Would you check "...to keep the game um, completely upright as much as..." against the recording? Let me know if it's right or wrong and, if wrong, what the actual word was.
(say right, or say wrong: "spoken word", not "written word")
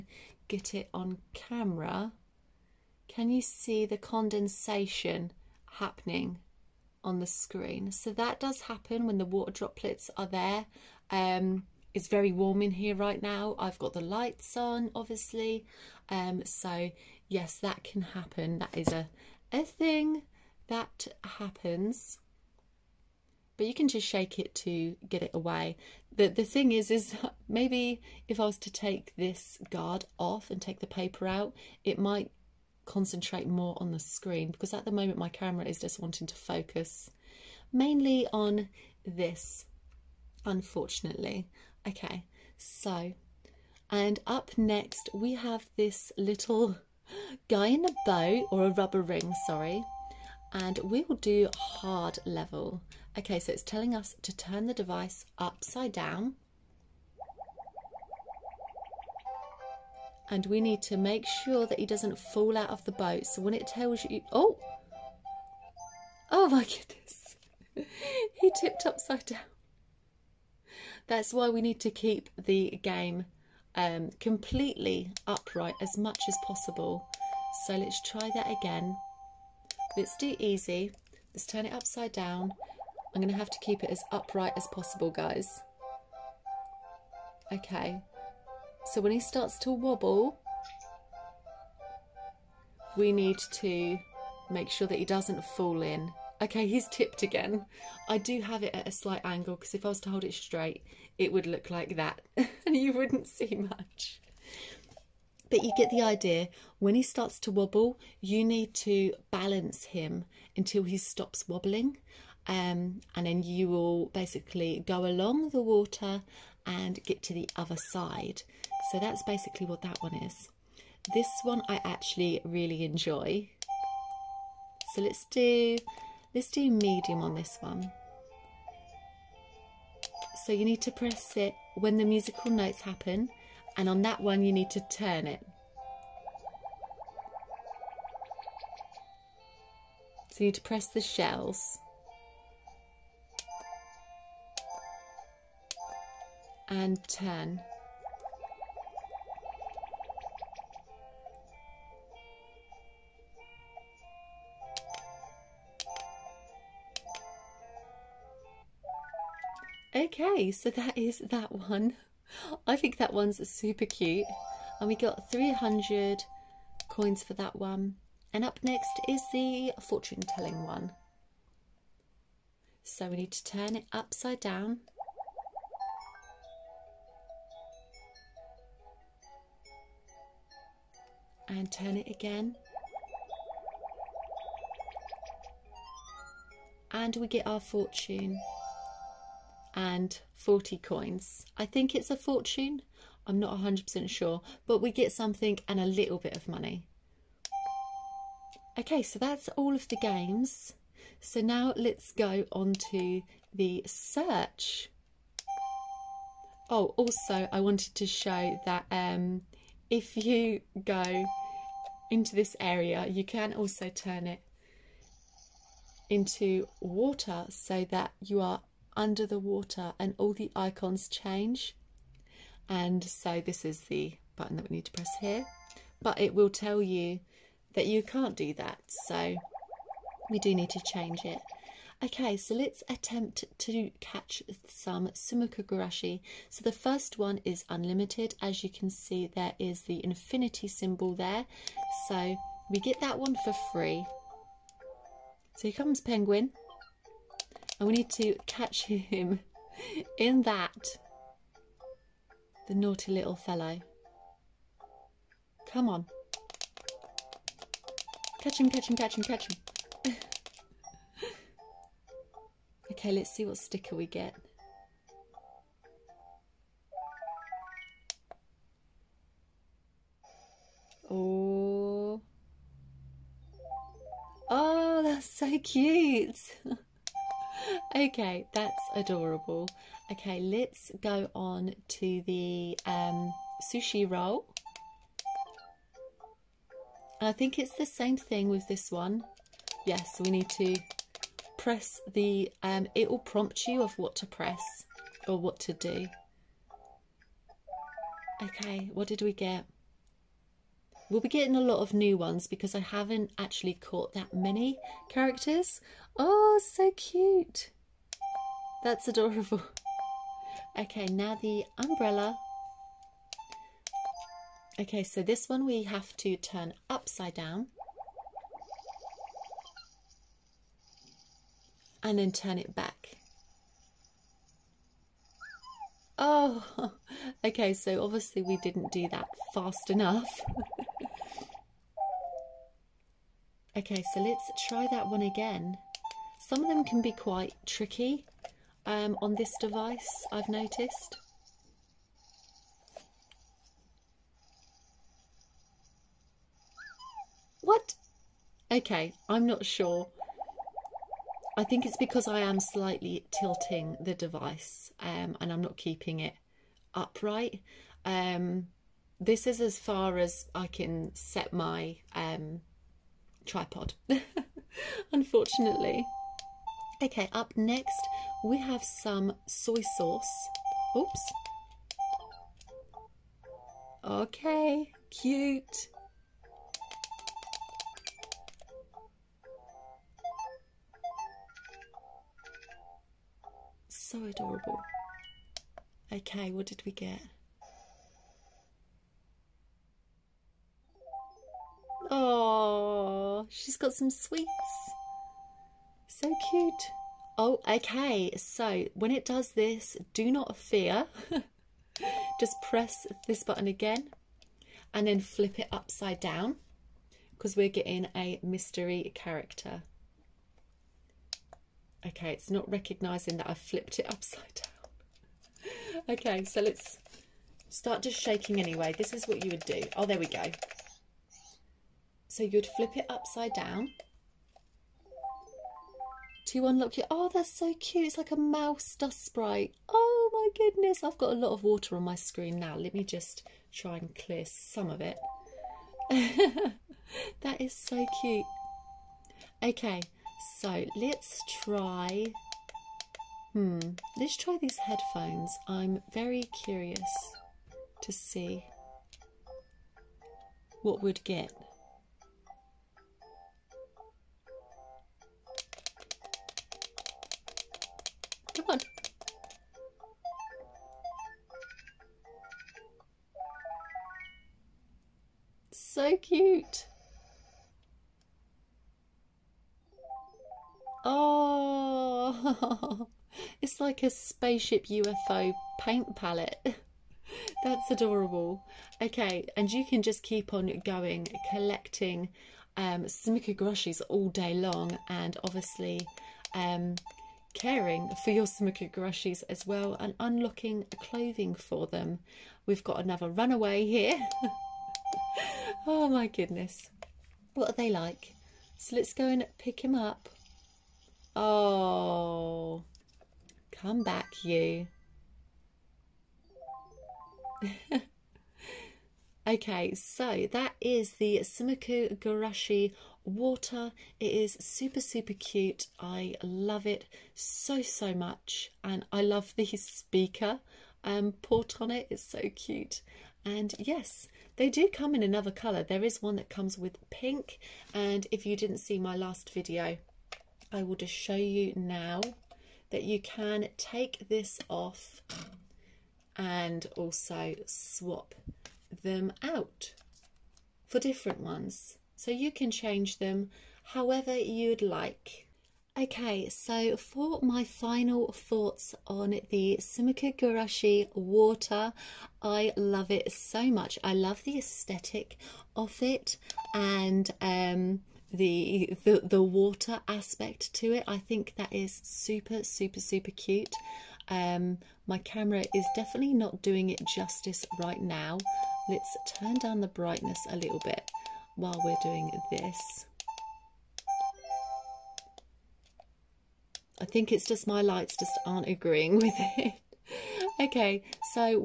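right.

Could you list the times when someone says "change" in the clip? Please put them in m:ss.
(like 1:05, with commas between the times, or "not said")
3:41, 3:50, 9:02.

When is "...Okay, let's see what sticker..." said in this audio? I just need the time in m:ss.
4:22.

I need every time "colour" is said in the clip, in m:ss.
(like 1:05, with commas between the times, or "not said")
8:45.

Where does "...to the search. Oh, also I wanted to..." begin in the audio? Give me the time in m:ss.
3:22.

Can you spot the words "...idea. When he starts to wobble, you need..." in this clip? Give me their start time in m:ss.
1:46.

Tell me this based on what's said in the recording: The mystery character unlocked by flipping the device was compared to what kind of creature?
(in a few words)
Mouse dust sprite.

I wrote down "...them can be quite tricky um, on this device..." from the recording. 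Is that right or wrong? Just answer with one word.
right.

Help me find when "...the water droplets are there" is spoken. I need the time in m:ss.
0:09.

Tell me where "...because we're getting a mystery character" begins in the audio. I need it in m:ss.
6:47.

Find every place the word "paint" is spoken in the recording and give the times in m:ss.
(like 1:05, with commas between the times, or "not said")
7:55.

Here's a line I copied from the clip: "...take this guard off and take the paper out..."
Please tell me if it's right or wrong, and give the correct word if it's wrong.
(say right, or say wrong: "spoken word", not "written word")
right.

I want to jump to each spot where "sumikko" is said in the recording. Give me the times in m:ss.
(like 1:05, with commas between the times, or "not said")
3:55, 8:31.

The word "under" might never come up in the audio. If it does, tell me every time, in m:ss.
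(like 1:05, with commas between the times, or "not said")
3:38.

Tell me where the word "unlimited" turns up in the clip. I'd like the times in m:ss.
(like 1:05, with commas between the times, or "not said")
3:57.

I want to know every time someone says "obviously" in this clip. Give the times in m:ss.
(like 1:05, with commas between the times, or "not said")
0:14, 5:28, 8:05.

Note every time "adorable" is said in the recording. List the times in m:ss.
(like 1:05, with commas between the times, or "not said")
4:38, 5:09, 6:24, 7:57.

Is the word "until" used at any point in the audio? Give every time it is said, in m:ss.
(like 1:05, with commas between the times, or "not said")
1:50.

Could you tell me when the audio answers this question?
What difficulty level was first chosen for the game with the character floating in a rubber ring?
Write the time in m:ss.
0:51.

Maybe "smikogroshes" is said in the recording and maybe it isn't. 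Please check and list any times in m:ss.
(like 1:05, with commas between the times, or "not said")
8:03, 8:08.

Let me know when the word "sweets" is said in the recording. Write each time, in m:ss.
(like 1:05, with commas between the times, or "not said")
6:34.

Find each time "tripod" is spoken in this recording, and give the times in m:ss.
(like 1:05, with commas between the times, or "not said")
6:03.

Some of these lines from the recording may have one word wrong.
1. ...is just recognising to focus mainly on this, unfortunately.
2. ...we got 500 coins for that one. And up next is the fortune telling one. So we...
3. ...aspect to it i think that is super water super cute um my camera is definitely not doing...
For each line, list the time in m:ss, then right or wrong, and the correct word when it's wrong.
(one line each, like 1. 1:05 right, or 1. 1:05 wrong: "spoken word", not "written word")
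1. 0:35 wrong: "wanting", not "recognising"
2. 2:44 wrong: "300", not "500"
3. 9:20 wrong: "super", not "water".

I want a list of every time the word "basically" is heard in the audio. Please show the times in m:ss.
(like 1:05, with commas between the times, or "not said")
1:54, 1:59.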